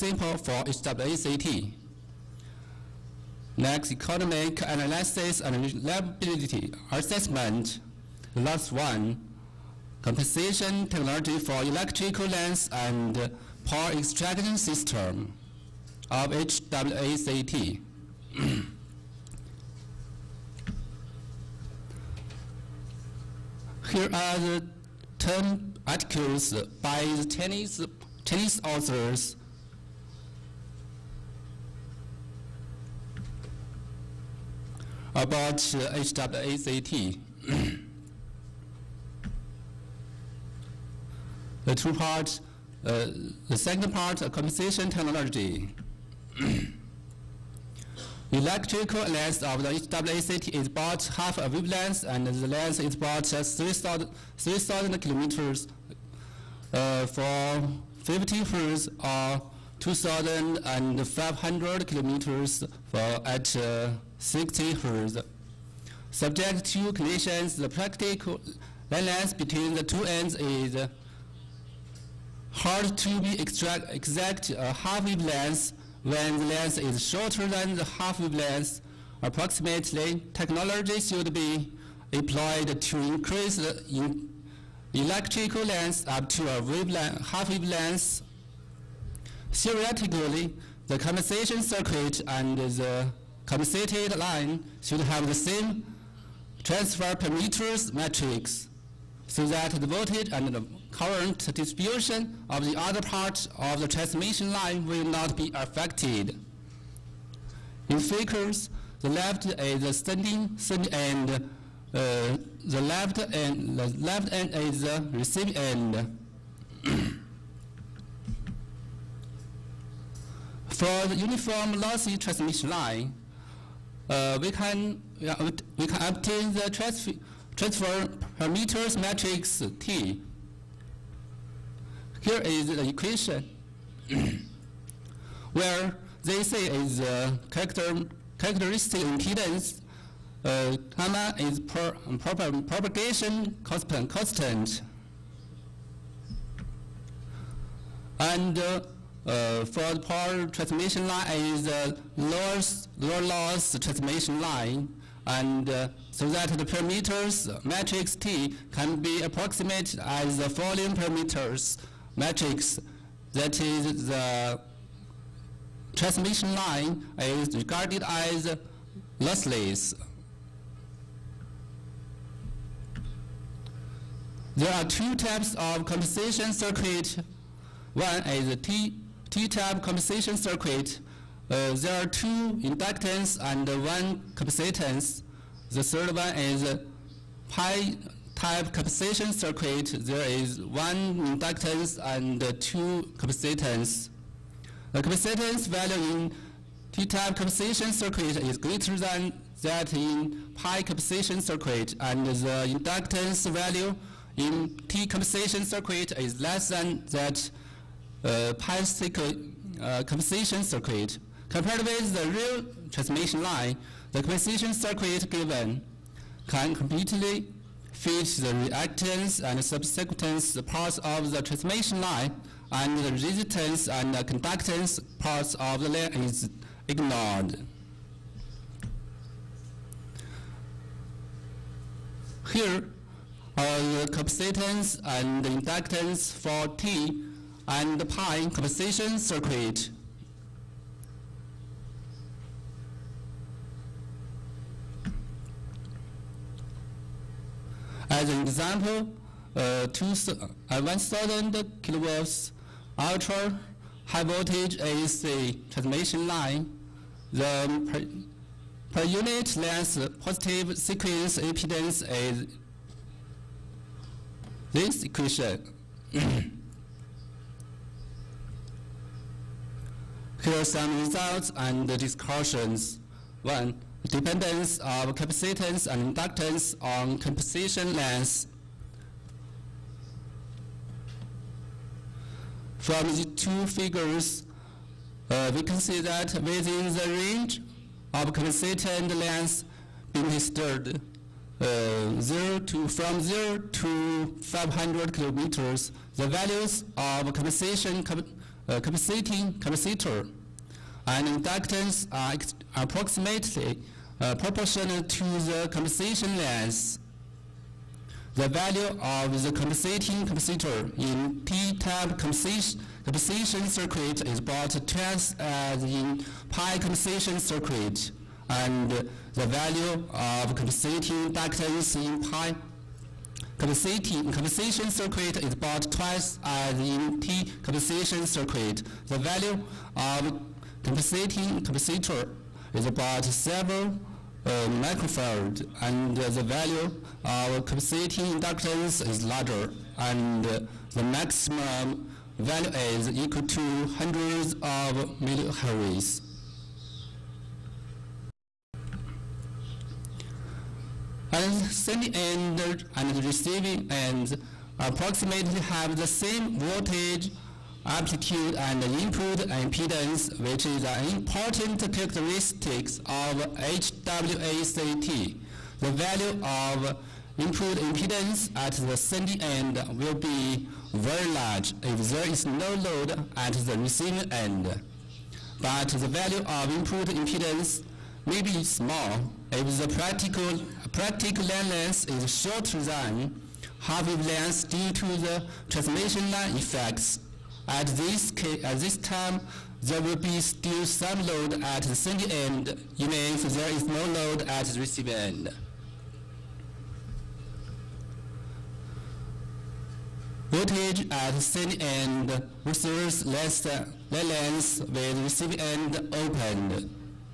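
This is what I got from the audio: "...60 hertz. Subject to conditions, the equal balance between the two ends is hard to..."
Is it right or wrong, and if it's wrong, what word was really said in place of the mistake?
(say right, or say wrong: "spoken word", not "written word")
wrong: "practical", not "equal".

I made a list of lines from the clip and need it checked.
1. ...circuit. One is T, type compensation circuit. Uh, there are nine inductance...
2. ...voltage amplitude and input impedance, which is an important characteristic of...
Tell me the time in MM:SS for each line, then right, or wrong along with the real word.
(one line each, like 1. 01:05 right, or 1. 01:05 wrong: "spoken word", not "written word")
1. 02:56 wrong: "two", not "nine"
2. 05:56 right.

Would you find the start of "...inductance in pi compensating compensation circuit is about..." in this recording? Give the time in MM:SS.
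05:21.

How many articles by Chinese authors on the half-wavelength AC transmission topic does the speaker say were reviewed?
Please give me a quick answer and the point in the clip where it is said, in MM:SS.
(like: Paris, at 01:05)
10, at 00:25.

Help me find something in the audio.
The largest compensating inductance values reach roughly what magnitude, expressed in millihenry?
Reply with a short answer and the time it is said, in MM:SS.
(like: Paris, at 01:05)
hundreds of millihenry, at 05:43.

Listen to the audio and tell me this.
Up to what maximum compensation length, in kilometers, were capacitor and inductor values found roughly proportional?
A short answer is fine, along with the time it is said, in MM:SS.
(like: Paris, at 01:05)
500 kilometers, at 04:54.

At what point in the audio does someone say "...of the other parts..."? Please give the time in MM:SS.
01:42.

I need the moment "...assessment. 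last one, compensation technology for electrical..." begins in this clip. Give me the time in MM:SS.
00:06.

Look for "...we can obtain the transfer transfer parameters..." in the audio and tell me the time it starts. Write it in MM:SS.
02:05.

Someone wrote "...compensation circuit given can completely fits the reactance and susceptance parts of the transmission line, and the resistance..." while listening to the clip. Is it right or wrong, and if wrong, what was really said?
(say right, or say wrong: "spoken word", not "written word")
right.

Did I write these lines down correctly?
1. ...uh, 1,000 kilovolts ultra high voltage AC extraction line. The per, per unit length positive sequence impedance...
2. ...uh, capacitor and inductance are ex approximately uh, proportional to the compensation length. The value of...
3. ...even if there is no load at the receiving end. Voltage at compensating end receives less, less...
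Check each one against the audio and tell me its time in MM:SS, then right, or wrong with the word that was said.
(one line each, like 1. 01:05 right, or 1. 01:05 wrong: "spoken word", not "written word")
1. 04:10 wrong: "transmission", not "extraction"
2. 04:58 right
3. 06:32 wrong: "sending", not "compensating".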